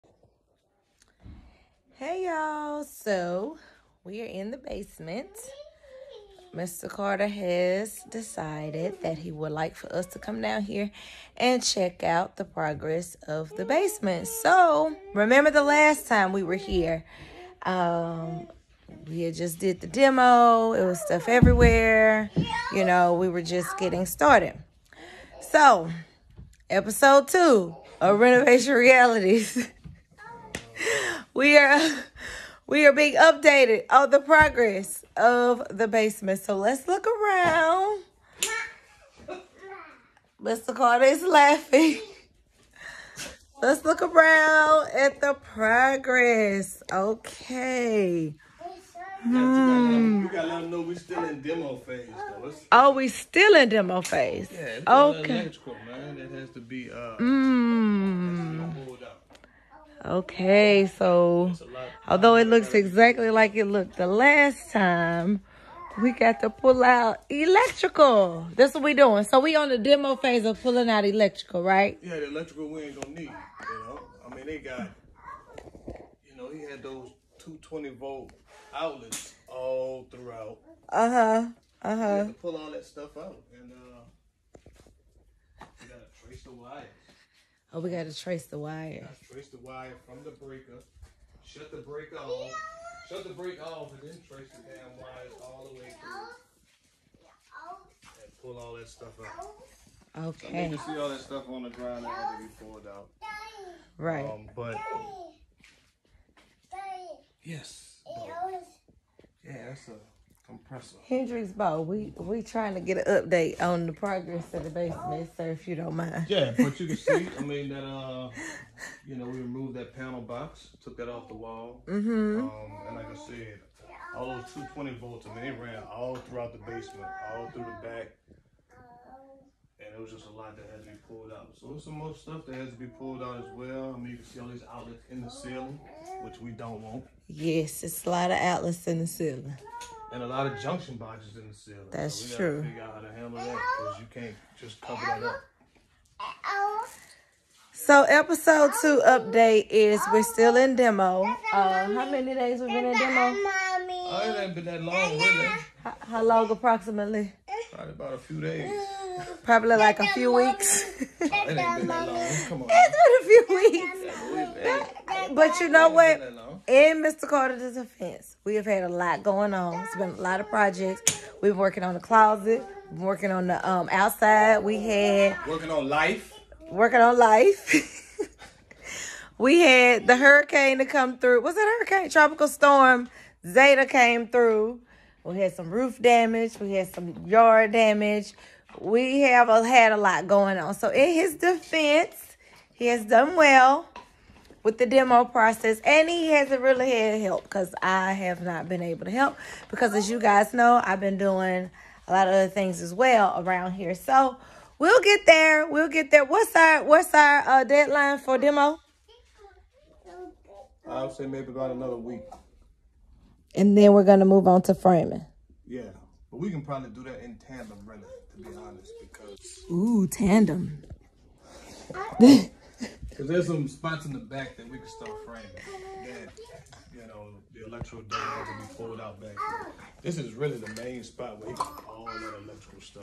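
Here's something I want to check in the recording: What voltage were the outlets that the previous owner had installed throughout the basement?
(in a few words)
220 volt.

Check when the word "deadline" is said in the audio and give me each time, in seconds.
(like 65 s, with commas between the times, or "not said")
207 s.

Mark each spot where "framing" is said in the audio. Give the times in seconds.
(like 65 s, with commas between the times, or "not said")
214 s, 225 s.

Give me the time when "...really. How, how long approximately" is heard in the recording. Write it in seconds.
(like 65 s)
155 s.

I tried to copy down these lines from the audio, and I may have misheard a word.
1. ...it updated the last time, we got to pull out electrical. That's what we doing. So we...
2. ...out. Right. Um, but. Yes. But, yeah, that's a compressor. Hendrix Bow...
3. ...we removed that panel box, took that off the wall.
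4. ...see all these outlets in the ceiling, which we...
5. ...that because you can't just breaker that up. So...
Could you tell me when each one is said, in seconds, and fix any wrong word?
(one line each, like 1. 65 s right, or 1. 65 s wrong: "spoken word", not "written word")
1. 63 s wrong: "looked", not "updated"
2. 102 s right
3. 119 s right
4. 134 s right
5. 143 s wrong: "cover", not "breaker".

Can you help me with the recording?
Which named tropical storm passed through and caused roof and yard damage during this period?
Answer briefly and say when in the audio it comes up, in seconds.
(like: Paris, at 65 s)
Zeta, at 183 s.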